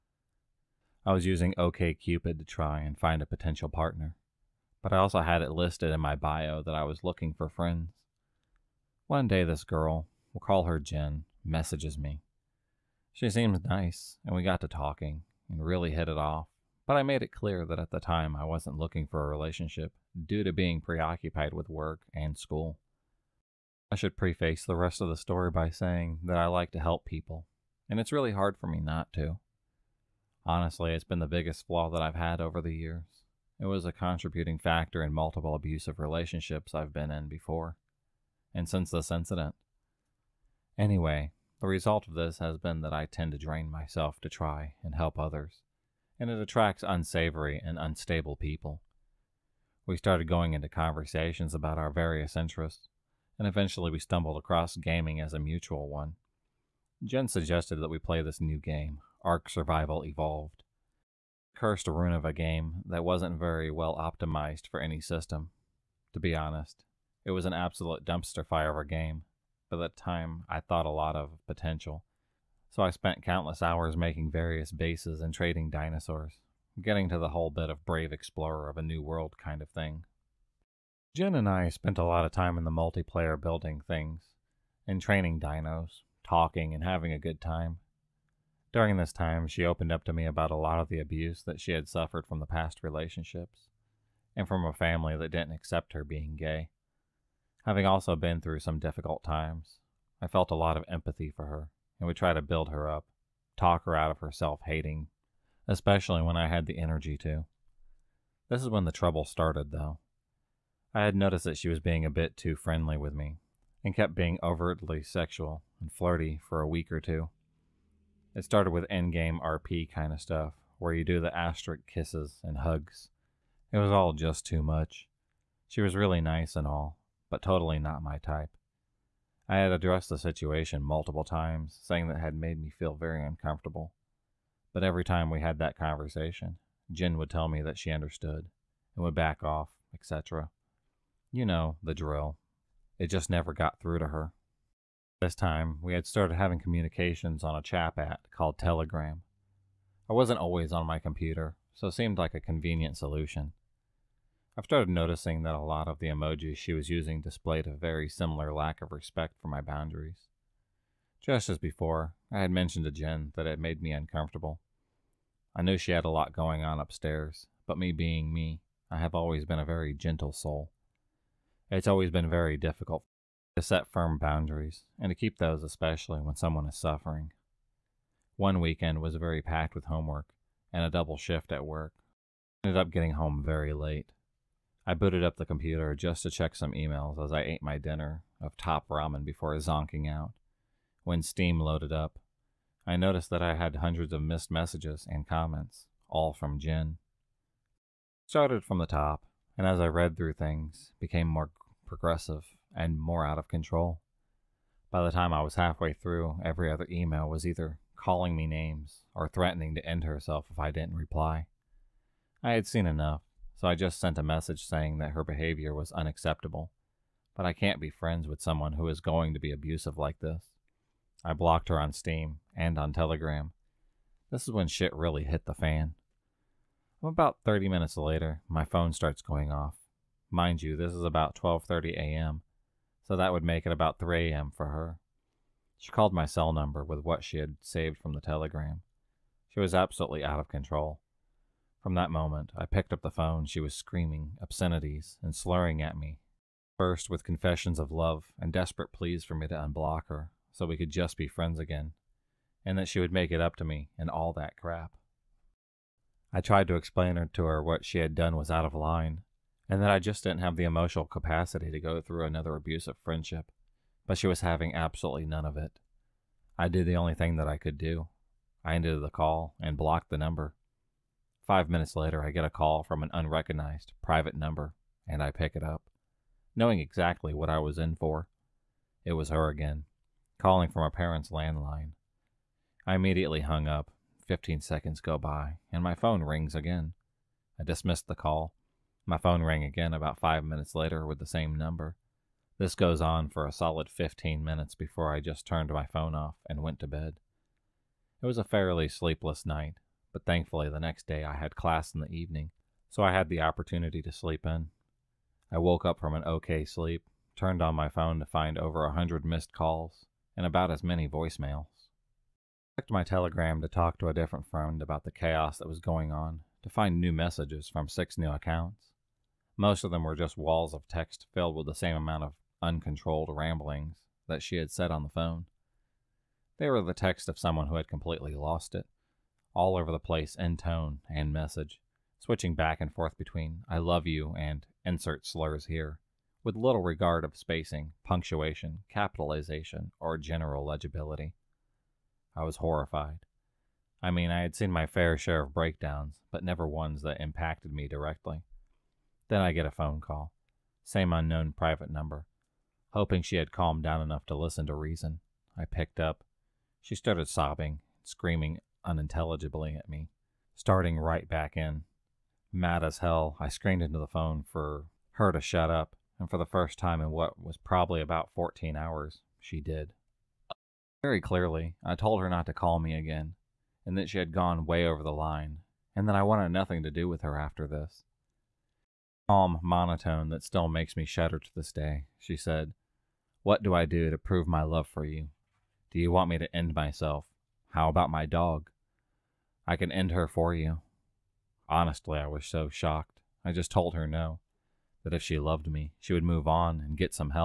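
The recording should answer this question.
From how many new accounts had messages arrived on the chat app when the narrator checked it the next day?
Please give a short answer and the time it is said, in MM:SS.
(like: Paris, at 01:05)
6, at 05:17.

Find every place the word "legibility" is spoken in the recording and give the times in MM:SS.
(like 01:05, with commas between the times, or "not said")
05:40.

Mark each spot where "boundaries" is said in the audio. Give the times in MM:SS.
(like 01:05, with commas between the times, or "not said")
02:39, 02:54.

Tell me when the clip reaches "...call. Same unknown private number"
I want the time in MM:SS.
05:49.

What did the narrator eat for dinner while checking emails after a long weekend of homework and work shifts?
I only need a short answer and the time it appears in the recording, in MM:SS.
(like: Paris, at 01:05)
top ramen, at 03:08.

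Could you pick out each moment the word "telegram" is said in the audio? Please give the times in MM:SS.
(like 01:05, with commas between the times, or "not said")
02:28, 03:42, 03:58, 05:13.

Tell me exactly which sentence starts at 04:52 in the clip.
This goes on for a solid 15 minutes before I just turned my phone off and went to bed.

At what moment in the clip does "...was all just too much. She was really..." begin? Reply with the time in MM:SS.
02:03.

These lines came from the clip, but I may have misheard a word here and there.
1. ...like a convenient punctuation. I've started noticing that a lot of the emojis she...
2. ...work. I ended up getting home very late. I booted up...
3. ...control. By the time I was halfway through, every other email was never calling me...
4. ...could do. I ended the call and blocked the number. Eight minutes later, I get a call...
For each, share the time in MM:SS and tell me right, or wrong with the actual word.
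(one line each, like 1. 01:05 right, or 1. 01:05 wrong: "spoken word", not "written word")
1. 02:32 wrong: "solution", not "punctuation"
2. 03:01 right
3. 03:23 wrong: "either", not "never"
4. 04:27 wrong: "Five", not "Eight".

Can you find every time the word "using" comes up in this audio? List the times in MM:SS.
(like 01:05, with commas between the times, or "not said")
00:01, 02:36.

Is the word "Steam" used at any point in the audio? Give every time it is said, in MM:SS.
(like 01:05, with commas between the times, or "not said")
03:11, 03:41.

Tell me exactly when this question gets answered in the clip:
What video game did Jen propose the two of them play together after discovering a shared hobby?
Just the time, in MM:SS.
00:59.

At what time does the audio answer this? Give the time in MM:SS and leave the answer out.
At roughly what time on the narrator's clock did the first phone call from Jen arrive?
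03:51.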